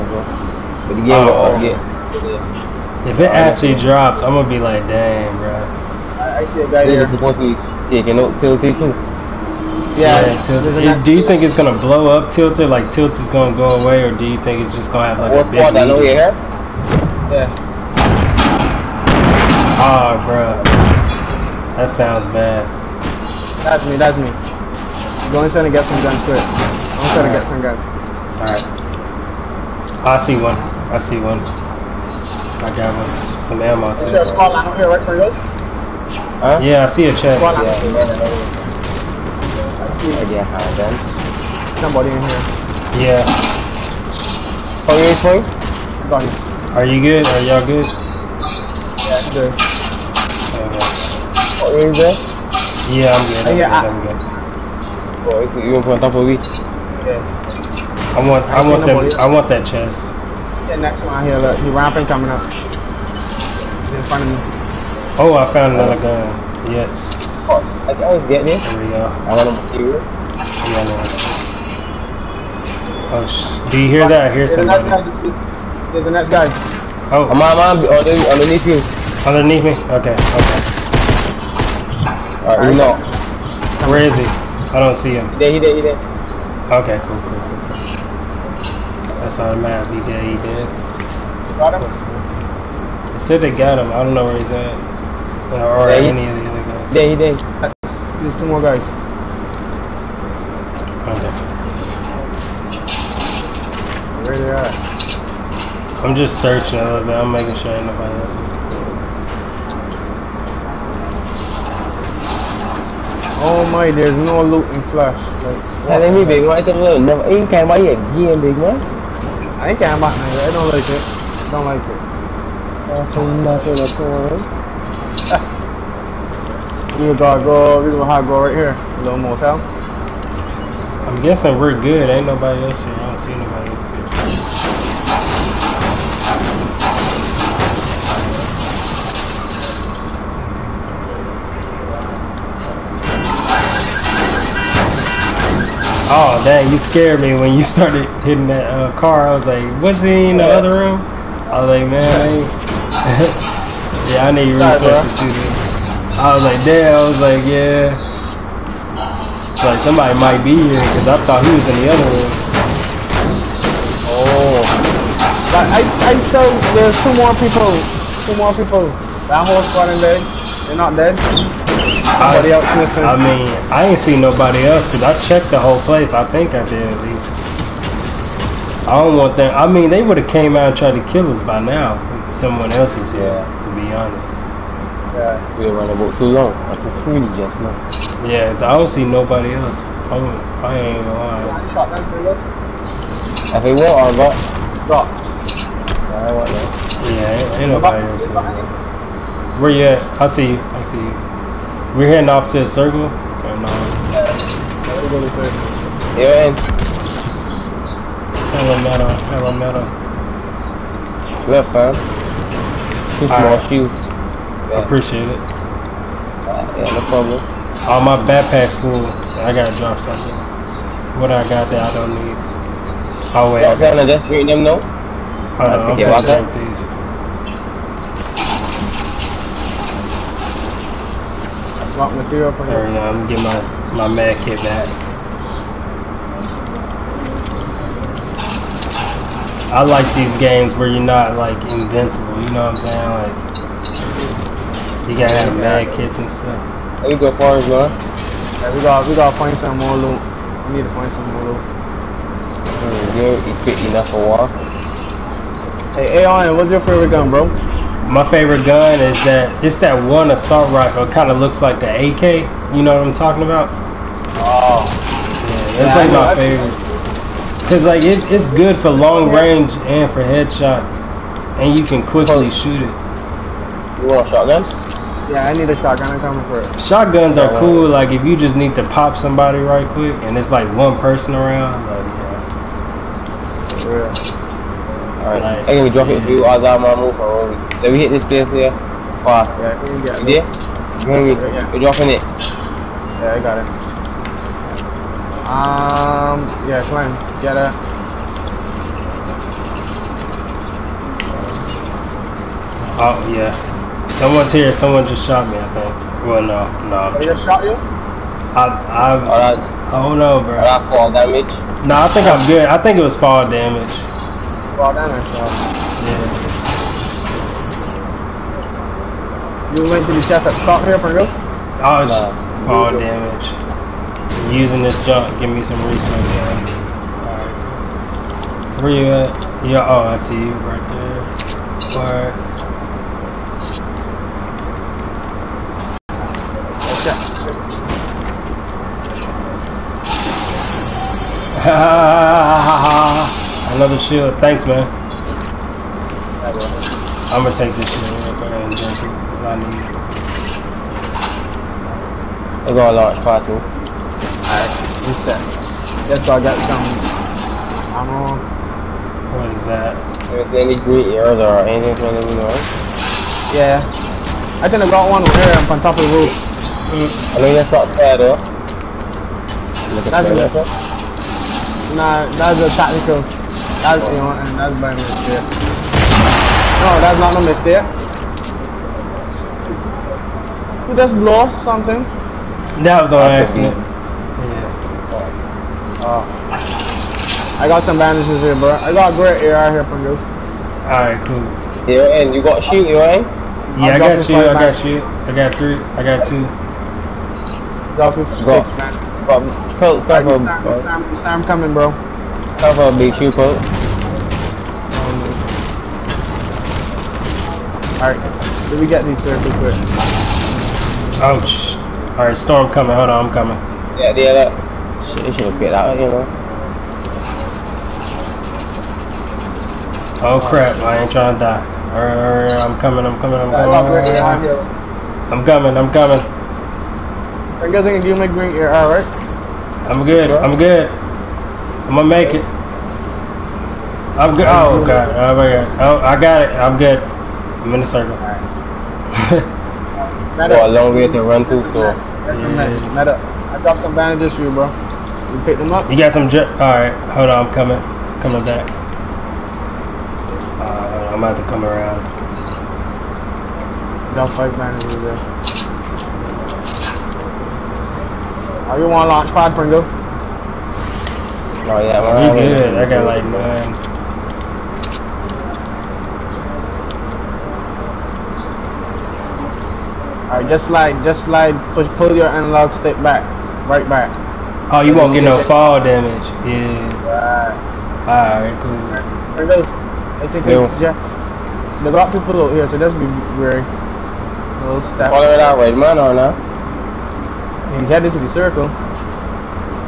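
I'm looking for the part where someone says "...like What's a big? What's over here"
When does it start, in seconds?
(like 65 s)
15 s.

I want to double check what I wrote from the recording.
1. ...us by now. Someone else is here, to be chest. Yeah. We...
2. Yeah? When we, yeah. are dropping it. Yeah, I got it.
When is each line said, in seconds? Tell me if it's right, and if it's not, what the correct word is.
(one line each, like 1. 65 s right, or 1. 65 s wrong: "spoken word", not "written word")
1. 181 s wrong: "honest", not "chest"
2. 290 s right.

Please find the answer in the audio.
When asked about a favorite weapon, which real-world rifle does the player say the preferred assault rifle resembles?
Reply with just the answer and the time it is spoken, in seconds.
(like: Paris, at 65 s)
AK, at 261 s.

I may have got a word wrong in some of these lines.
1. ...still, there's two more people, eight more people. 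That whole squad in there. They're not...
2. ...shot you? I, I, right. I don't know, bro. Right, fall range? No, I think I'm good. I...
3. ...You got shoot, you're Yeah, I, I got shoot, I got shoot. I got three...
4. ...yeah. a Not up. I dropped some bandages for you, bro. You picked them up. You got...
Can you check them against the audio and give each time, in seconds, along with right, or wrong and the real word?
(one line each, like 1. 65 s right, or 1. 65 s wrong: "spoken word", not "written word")
1. 166 s wrong: "two", not "eight"
2. 307 s wrong: "damage", not "range"
3. 392 s right
4. 442 s right.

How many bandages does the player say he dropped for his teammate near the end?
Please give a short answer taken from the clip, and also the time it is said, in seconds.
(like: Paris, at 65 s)
5, at 454 s.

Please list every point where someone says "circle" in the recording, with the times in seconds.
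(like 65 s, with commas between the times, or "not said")
202 s, 437 s, 488 s.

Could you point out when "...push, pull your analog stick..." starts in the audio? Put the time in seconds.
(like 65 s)
471 s.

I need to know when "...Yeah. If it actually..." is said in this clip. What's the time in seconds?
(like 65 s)
1 s.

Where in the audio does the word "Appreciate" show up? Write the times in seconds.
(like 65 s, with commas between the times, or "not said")
214 s.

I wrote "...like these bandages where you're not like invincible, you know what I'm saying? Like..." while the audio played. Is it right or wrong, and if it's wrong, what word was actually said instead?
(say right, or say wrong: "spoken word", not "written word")
wrong: "games", not "bandages".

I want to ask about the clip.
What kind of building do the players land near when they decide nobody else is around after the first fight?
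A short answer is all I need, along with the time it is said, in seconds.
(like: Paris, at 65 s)
A little motel, at 128 s.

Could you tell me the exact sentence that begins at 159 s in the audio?
Like, somebody might be here because I thought he was in the other room.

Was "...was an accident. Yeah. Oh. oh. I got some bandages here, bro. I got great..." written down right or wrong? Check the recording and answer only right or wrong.
right.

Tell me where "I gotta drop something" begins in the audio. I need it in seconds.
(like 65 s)
219 s.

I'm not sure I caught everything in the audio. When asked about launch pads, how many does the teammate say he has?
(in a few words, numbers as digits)
9.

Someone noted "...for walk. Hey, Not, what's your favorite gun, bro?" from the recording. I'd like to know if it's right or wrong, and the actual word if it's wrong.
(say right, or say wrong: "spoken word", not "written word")
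wrong: "Aon", not "Not".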